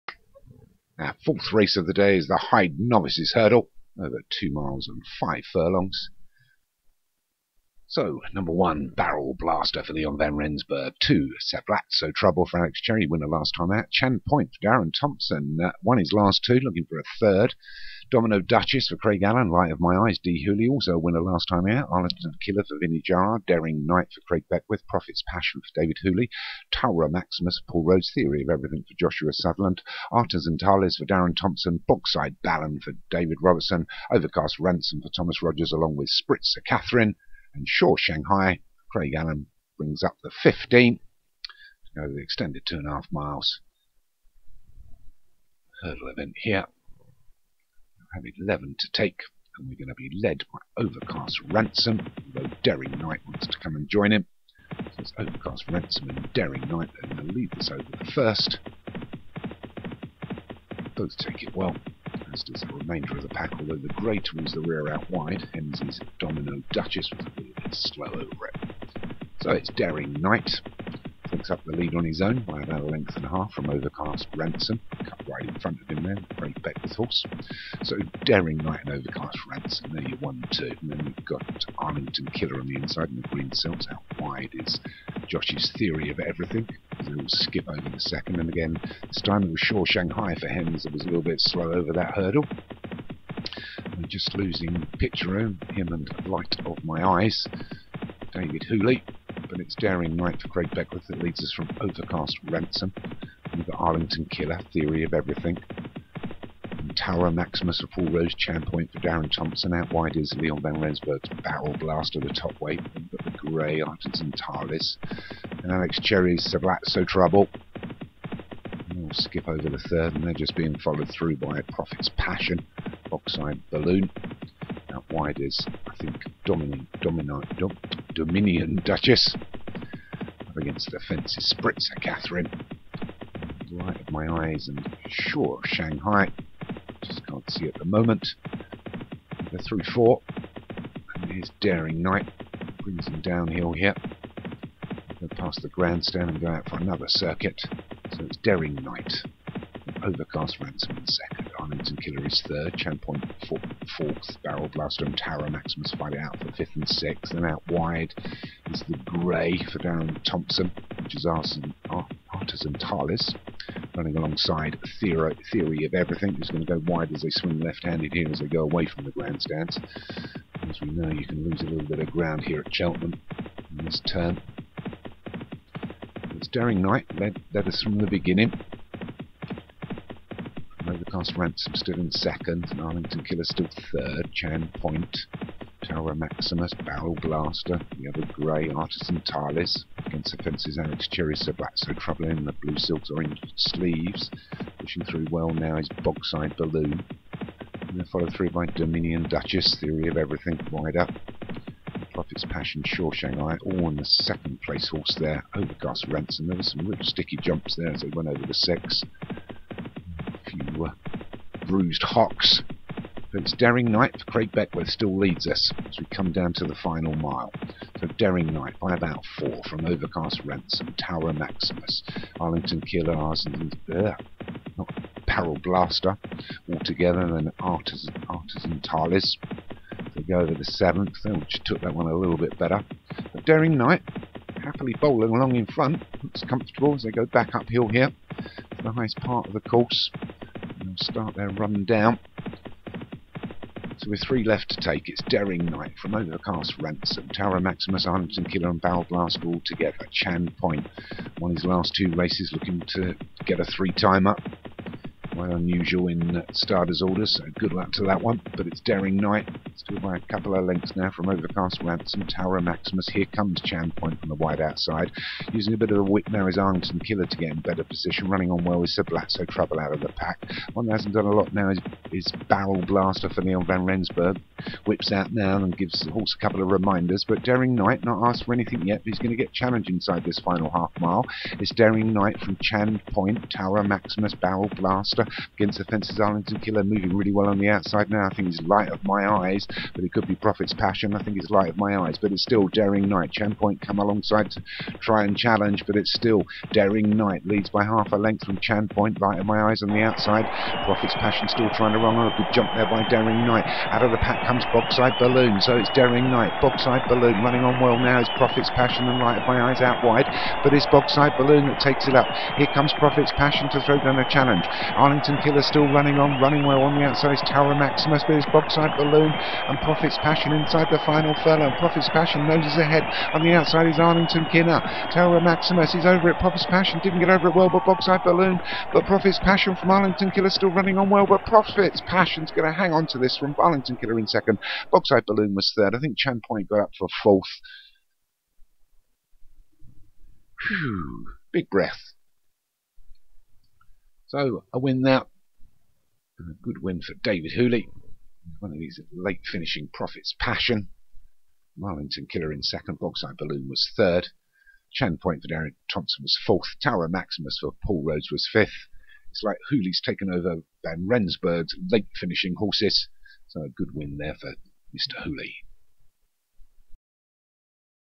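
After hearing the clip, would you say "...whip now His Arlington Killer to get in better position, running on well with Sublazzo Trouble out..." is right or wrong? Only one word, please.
right.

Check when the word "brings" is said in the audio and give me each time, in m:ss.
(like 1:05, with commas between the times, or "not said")
0:39, 2:22.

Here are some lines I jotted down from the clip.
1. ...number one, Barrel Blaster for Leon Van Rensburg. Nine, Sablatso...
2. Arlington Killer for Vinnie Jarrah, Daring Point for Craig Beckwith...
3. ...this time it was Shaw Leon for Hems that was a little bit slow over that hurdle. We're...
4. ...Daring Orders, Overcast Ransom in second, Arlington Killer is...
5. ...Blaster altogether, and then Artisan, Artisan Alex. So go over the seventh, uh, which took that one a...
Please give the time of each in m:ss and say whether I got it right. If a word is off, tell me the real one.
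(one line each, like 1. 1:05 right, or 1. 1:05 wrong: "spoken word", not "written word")
1. 0:08 wrong: "Two", not "Nine"
2. 0:21 wrong: "Knight", not "Point"
3. 1:29 wrong: "Shanghai", not "Leon"
4. 2:28 wrong: "Knight", not "Orders"
5. 3:45 wrong: "Talis", not "Alex".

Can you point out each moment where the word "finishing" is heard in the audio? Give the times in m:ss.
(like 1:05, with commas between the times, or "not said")
5:49, 6:02.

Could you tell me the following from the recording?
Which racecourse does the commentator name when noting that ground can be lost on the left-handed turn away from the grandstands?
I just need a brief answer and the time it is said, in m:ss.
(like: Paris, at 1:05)
Cheltenham, at 2:52.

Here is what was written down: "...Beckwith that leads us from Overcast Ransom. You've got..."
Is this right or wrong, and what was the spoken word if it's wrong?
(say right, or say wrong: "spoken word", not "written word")
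right.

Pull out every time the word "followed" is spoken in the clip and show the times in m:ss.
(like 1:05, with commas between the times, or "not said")
2:00, 3:18.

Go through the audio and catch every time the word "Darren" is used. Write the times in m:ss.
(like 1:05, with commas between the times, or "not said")
0:14, 0:31, 1:49, 2:39, 5:55.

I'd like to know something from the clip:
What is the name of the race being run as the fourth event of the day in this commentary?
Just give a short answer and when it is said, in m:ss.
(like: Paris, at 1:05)
Hyde Novices Hurdle, at 0:02.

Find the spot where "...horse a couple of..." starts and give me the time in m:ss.
4:36.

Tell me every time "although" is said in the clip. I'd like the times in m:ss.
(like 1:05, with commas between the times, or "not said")
0:52, 1:03.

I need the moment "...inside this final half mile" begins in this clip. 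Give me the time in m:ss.
4:39.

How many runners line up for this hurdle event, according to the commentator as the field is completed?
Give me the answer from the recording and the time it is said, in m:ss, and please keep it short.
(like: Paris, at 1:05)
15, at 0:40.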